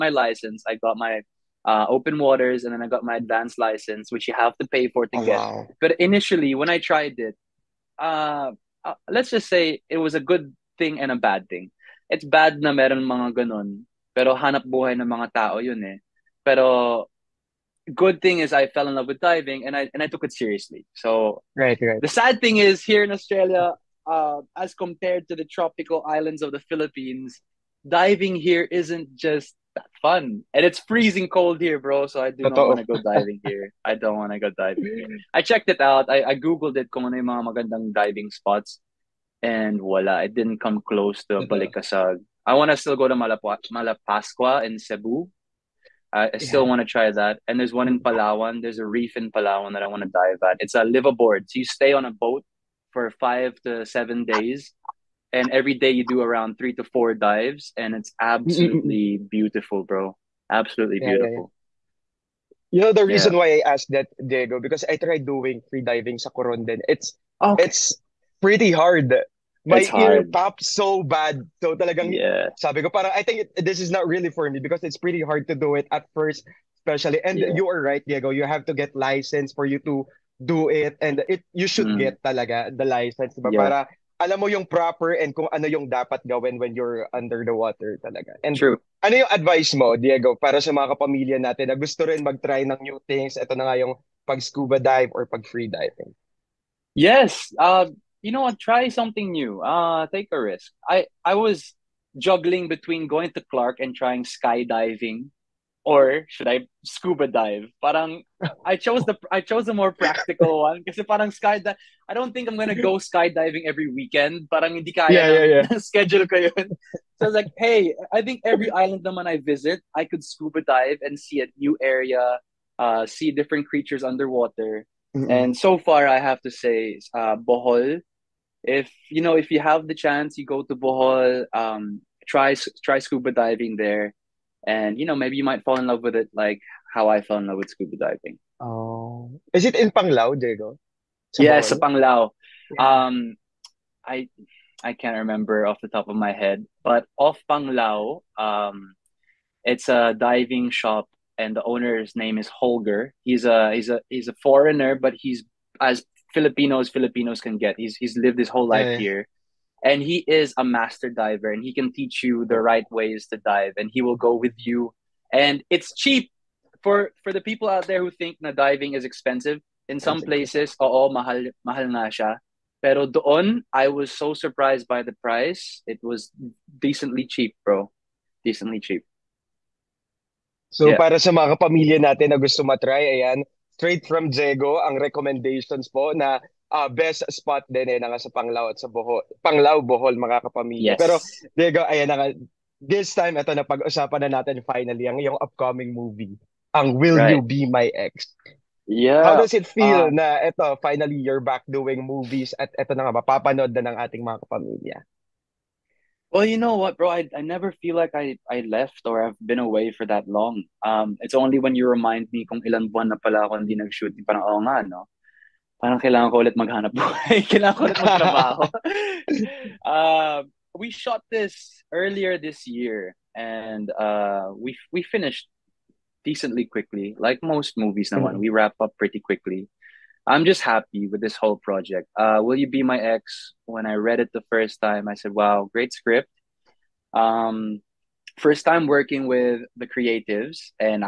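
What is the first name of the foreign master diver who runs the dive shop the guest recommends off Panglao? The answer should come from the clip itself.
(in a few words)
Holger.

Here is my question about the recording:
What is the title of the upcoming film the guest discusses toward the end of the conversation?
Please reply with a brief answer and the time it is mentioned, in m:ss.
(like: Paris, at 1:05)
Will You Be My Ex, at 3:52.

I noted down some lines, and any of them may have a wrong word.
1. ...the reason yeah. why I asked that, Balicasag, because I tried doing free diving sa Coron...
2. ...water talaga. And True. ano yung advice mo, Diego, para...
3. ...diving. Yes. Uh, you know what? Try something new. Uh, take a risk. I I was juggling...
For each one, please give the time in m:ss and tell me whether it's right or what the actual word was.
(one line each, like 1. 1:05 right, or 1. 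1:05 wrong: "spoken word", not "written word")
1. 1:02 wrong: "Diego", not "Balicasag"
2. 1:27 right
3. 1:35 right.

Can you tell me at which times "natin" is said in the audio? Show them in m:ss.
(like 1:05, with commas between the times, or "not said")
1:31, 3:02, 3:14.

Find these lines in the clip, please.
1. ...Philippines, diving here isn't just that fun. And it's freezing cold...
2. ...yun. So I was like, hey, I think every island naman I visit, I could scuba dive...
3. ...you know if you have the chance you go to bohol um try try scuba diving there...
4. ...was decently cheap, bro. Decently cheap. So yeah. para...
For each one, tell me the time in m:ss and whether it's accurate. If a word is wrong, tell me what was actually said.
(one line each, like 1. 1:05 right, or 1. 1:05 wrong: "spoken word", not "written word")
1. 0:26 right
2. 1:56 right
3. 2:09 right
4. 2:56 right.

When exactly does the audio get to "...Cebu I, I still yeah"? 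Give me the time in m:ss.
0:44.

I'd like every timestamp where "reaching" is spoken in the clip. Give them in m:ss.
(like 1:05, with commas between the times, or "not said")
not said.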